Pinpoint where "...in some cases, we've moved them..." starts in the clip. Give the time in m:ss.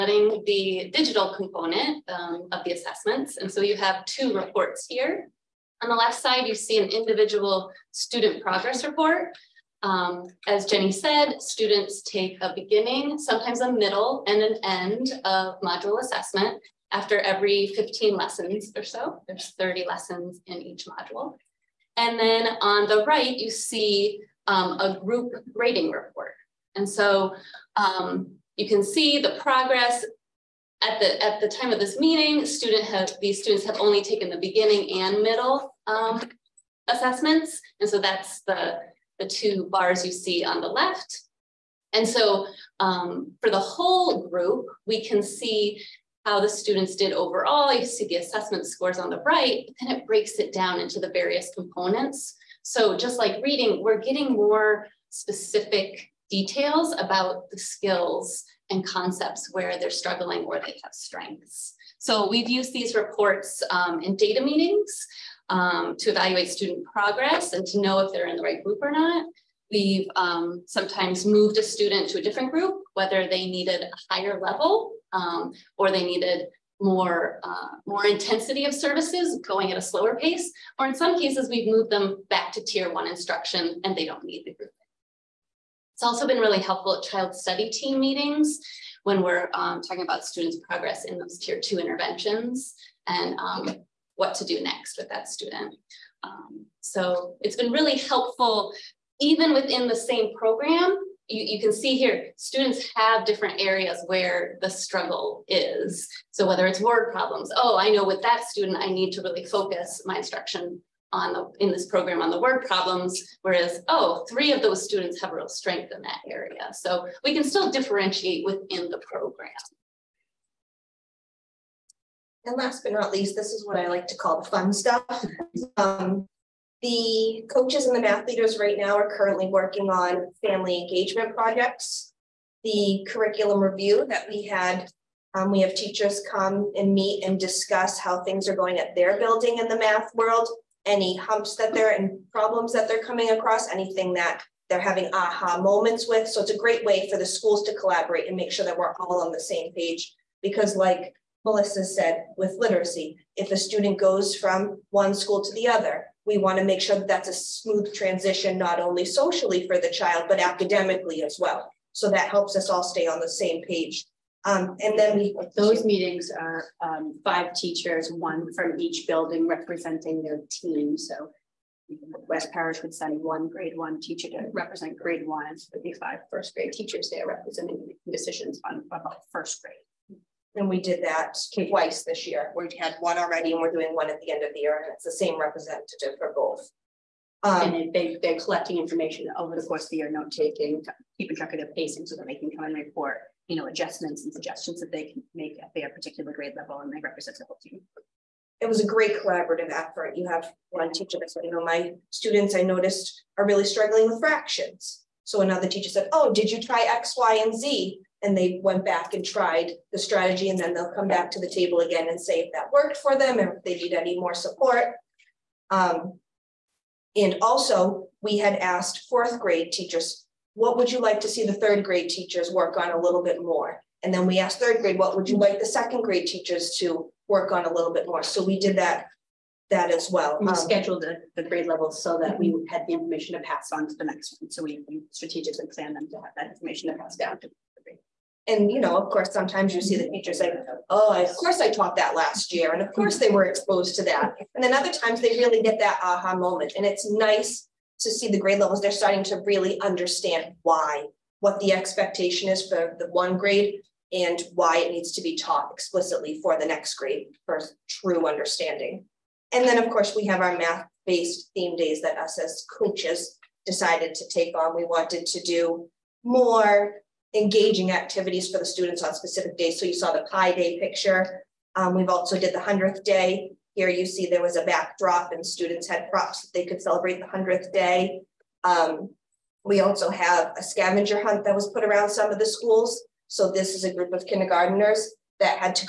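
1:20.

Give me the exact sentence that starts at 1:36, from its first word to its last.
Um, so it's been really helpful even within the same program.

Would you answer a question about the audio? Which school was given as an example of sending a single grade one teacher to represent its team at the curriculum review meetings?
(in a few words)
West Parish.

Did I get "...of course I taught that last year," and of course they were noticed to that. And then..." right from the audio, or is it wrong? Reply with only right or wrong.
wrong.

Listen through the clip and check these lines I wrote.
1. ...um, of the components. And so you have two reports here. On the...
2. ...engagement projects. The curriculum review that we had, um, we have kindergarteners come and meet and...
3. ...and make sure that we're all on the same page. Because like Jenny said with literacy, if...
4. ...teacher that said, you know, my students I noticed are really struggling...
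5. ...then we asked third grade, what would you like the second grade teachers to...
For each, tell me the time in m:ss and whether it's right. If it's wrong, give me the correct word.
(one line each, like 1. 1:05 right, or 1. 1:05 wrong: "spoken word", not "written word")
1. 0:02 wrong: "assessments", not "components"
2. 2:10 wrong: "teachers", not "kindergarteners"
3. 2:28 wrong: "Melissa", not "Jenny"
4. 3:20 right
5. 3:44 right.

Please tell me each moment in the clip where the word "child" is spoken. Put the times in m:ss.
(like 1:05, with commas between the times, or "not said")
1:27, 2:39.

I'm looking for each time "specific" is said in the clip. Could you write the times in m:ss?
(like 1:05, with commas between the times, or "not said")
0:55, 4:29.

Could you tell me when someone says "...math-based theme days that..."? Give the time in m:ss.
4:20.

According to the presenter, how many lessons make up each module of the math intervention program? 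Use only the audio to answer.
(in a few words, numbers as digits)
30.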